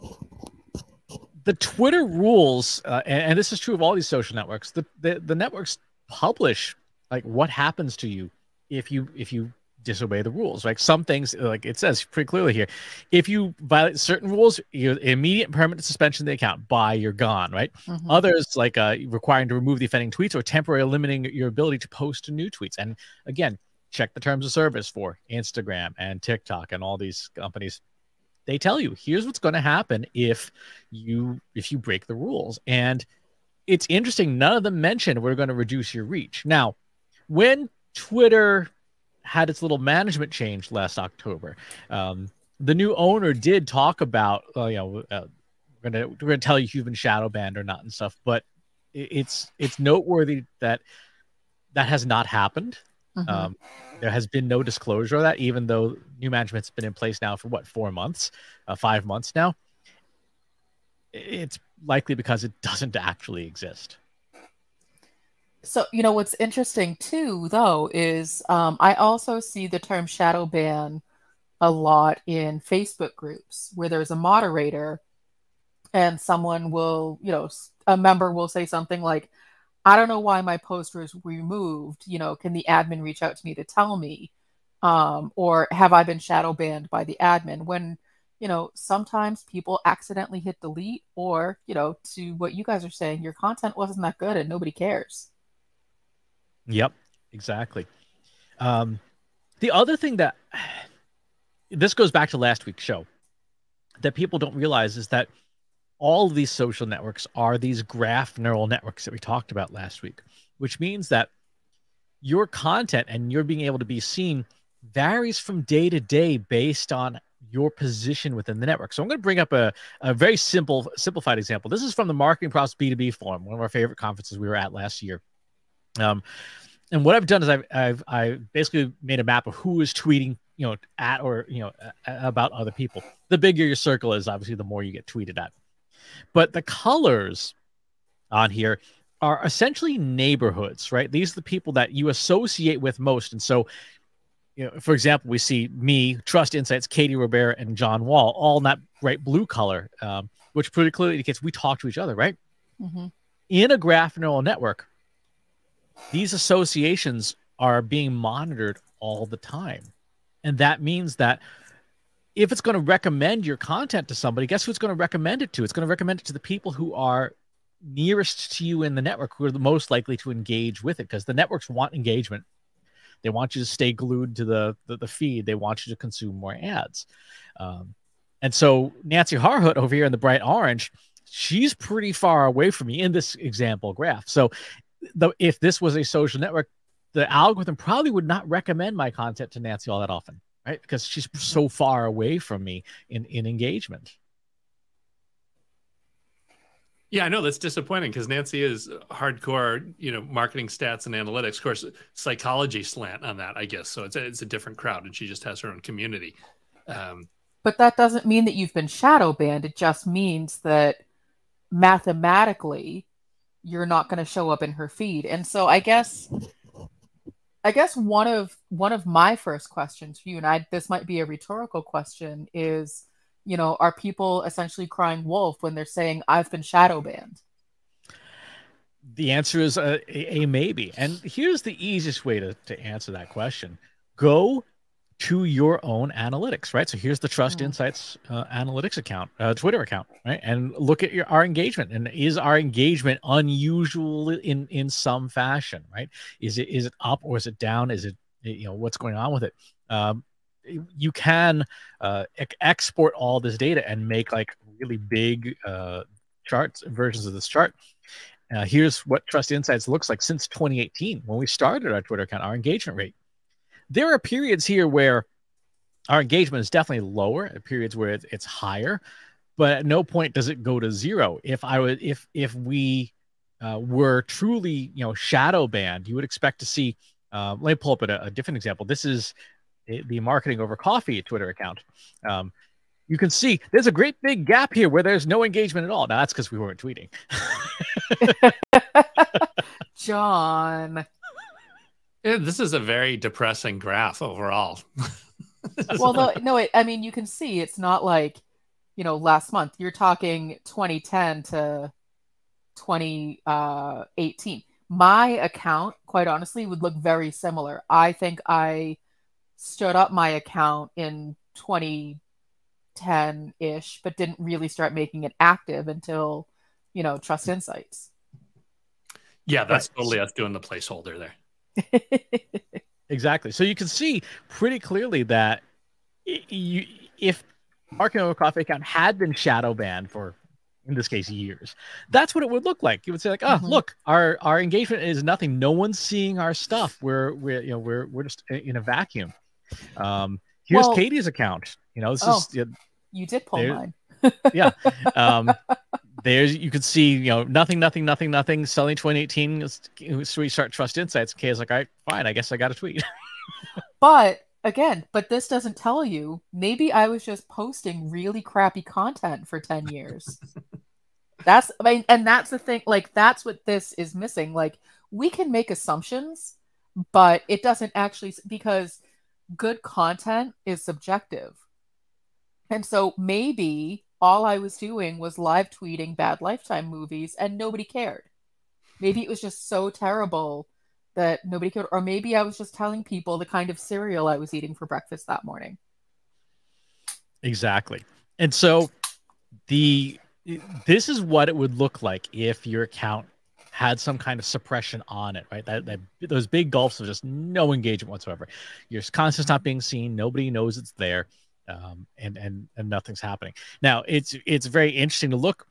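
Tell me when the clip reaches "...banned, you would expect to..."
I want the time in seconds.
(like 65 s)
275 s.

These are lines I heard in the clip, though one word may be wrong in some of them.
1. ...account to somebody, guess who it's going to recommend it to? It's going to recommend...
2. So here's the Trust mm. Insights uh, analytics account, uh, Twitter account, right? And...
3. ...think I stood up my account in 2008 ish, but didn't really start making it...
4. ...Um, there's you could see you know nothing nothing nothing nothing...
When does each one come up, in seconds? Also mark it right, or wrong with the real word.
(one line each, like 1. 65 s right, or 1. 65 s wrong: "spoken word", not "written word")
1. 163 s wrong: "content", not "account"
2. 236 s right
3. 308 s wrong: "2010", not "2008"
4. 345 s right.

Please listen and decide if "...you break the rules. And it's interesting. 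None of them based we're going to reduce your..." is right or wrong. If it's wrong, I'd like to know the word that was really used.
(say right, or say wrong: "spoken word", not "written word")
wrong: "mentioned", not "based".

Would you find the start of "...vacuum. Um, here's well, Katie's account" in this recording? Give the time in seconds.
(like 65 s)
338 s.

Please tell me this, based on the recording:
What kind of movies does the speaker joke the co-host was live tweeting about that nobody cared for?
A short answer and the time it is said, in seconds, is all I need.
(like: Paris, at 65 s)
Lifetime movies, at 376 s.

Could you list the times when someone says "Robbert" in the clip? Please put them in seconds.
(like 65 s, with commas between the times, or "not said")
147 s.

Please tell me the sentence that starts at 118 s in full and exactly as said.
So I'm going to bring up a, a very simple, simplified example.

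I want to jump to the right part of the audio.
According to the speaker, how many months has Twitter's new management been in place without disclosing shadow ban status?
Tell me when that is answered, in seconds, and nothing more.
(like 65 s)
58 s.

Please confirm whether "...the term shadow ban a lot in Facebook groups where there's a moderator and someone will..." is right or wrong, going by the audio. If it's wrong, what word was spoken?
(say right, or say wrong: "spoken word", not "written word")
right.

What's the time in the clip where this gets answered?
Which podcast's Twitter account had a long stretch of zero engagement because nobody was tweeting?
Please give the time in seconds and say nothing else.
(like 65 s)
280 s.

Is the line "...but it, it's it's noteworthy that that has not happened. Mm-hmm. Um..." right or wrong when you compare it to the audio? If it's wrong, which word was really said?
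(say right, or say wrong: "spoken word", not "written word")
right.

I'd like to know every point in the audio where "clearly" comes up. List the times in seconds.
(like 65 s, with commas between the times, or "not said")
12 s, 150 s, 324 s.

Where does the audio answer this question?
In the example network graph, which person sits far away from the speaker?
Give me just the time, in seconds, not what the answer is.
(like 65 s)
179 s.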